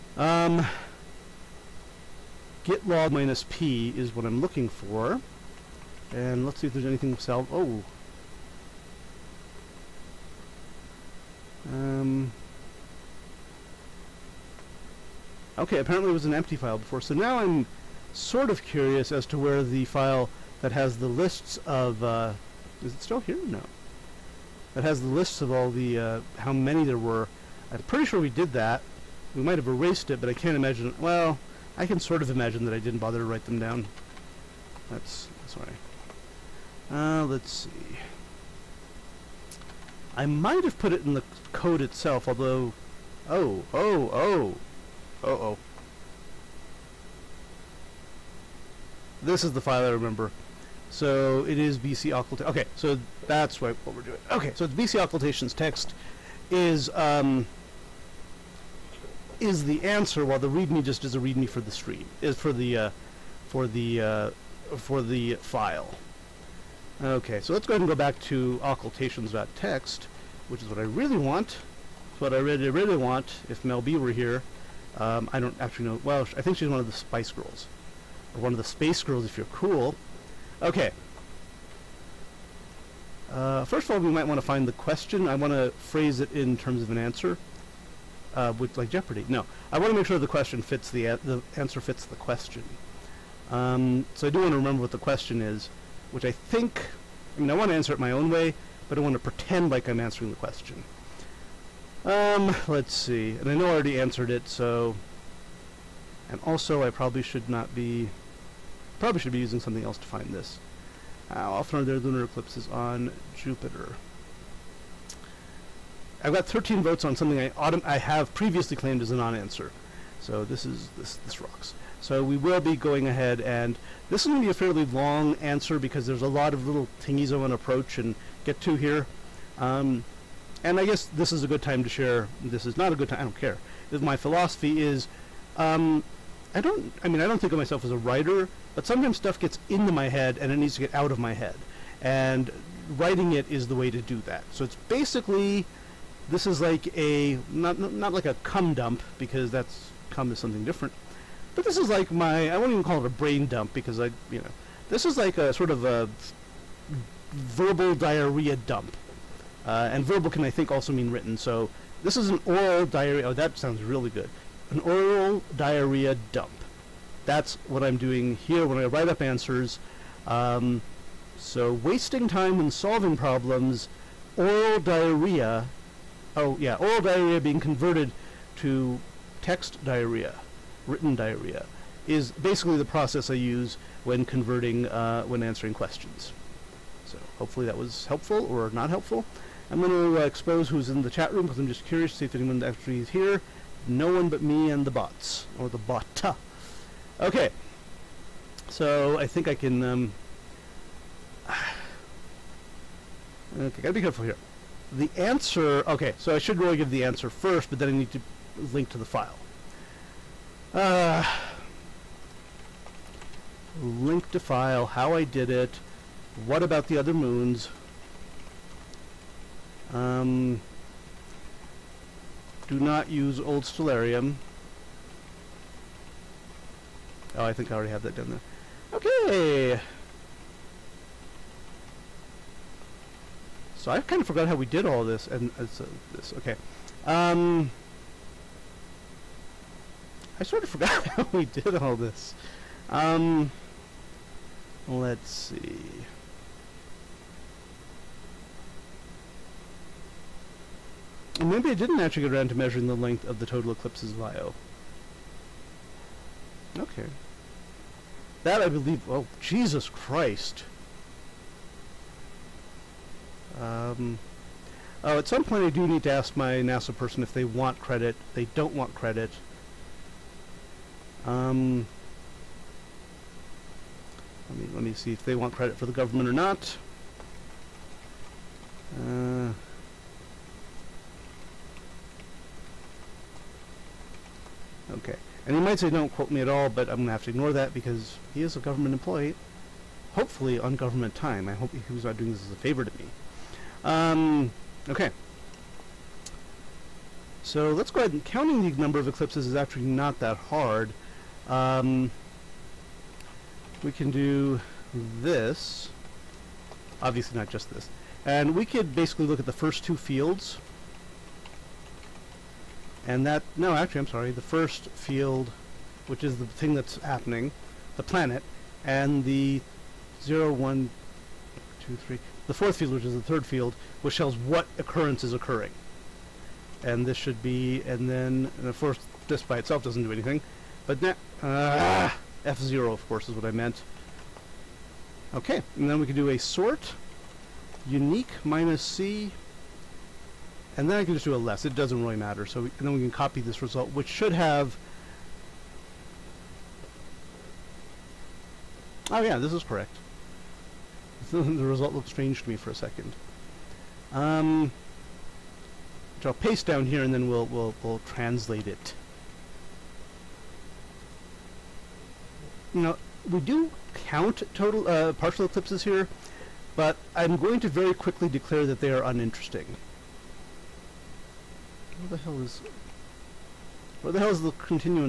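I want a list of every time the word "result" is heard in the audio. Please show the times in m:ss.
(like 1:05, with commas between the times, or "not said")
5:43, 5:51.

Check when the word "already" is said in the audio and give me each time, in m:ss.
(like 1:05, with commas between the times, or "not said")
1:43, 3:47.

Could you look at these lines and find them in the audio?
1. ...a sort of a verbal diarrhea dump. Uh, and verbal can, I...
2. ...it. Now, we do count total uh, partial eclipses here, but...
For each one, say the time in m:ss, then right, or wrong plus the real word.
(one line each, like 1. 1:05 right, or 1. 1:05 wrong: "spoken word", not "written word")
1. 2:35 right
2. 5:58 right.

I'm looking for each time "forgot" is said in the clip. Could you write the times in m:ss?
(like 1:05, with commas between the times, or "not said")
3:54, 4:00.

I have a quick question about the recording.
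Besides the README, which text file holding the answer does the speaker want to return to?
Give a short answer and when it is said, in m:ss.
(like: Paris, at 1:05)
occultations.txt, at 1:08.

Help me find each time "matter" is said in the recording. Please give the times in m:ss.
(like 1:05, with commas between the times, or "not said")
5:42.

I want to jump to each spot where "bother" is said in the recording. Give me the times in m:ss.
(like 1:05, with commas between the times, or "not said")
0:32.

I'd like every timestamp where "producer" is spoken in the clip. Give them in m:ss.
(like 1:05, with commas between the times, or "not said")
not said.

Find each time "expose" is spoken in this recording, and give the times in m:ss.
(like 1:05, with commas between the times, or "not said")
3:10.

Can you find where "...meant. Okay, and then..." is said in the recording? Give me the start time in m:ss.
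5:33.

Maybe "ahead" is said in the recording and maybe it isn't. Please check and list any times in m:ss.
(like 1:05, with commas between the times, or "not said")
1:07, 2:03, 4:58.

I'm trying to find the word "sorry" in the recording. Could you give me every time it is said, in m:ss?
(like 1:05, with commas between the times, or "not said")
0:35, 5:14.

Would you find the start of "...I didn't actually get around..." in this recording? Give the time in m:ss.
4:11.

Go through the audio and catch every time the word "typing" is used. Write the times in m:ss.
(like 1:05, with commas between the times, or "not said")
not said.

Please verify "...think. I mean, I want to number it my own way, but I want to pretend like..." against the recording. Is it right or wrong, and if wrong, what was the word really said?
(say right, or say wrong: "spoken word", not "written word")
wrong: "answer", not "number".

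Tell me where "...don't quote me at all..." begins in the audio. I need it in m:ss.
4:45.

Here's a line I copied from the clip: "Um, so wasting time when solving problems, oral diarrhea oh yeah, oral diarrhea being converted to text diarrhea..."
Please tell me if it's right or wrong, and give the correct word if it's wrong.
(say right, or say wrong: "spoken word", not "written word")
right.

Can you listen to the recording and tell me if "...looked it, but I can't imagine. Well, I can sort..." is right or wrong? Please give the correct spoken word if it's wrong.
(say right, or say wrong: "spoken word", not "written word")
wrong: "erased", not "looked".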